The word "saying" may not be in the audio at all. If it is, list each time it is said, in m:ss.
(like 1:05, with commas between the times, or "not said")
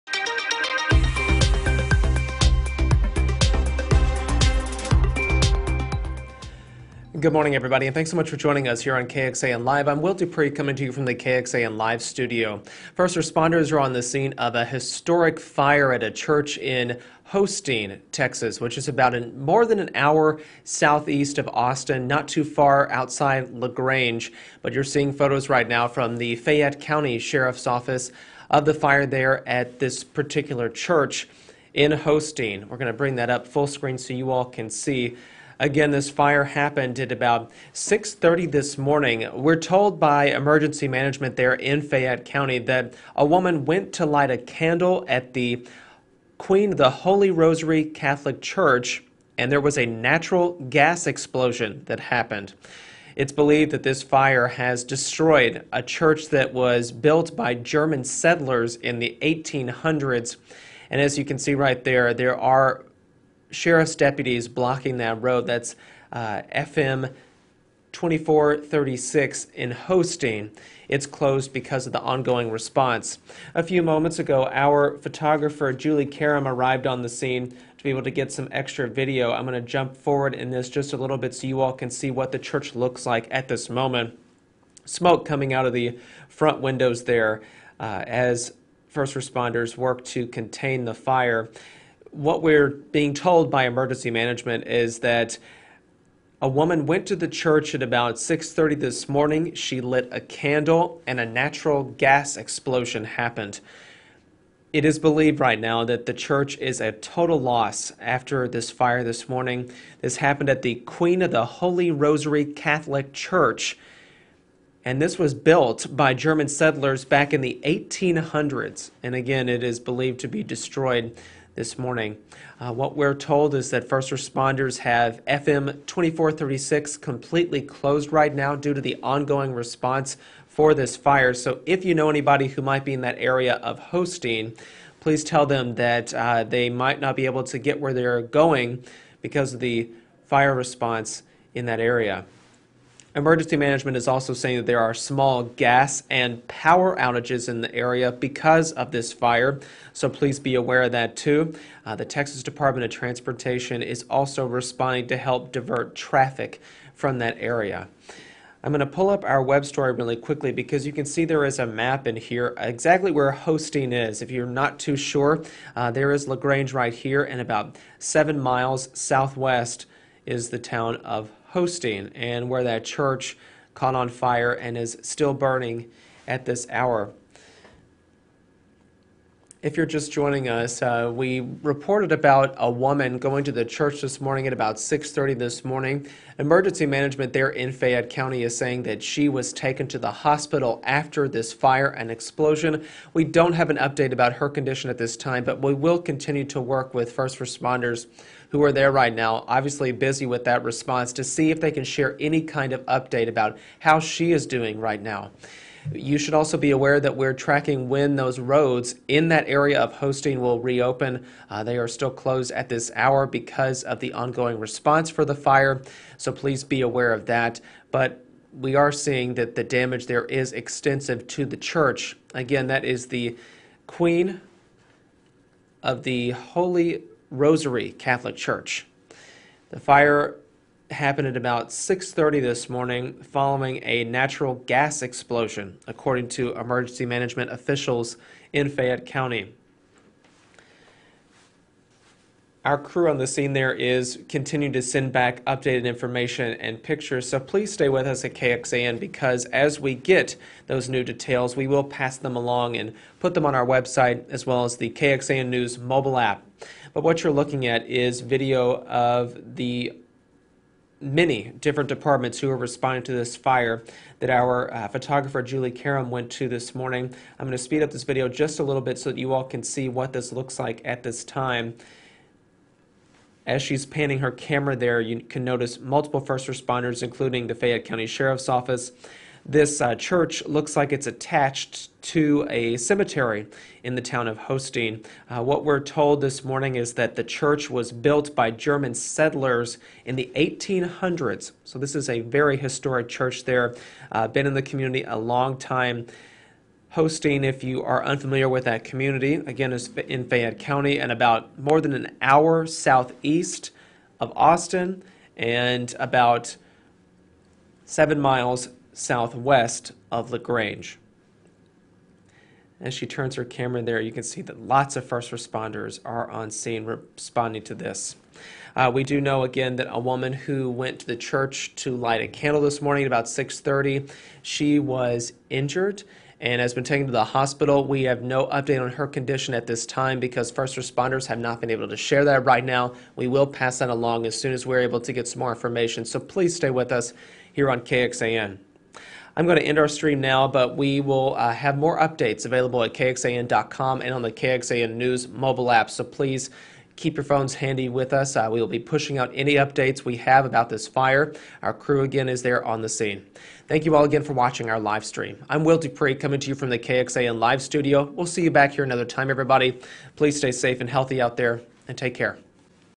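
2:24, 3:08.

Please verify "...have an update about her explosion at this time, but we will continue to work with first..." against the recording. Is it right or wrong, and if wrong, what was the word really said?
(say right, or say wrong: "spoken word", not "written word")
wrong: "condition", not "explosion".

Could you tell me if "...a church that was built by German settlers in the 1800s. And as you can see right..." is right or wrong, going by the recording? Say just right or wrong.
right.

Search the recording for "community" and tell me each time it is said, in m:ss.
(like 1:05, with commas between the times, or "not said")
4:54, 4:58.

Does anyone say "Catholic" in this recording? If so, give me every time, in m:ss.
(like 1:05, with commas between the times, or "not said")
0:47, 1:52, 3:47.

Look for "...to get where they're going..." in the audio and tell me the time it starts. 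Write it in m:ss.
2:17.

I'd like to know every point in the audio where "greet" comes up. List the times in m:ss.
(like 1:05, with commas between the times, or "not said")
not said.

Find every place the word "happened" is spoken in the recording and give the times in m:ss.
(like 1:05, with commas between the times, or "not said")
0:36, 0:51, 1:43, 1:50, 3:50.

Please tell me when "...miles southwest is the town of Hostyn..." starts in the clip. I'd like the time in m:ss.
2:48.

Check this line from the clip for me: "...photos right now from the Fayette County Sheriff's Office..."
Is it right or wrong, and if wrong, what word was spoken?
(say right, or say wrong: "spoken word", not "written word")
right.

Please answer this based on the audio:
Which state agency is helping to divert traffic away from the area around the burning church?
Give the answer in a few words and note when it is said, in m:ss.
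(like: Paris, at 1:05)
Texas Department of Transportation, at 2:32.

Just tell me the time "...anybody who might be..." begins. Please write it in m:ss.
2:12.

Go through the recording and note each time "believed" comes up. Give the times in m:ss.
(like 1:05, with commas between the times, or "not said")
0:53, 1:44, 1:59.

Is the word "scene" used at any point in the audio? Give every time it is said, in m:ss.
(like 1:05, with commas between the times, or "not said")
0:14, 1:17, 4:03, 5:16, 5:52.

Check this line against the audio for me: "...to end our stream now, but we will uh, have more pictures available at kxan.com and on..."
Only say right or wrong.
wrong.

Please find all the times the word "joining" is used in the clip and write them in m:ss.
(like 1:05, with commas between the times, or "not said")
0:08, 3:00.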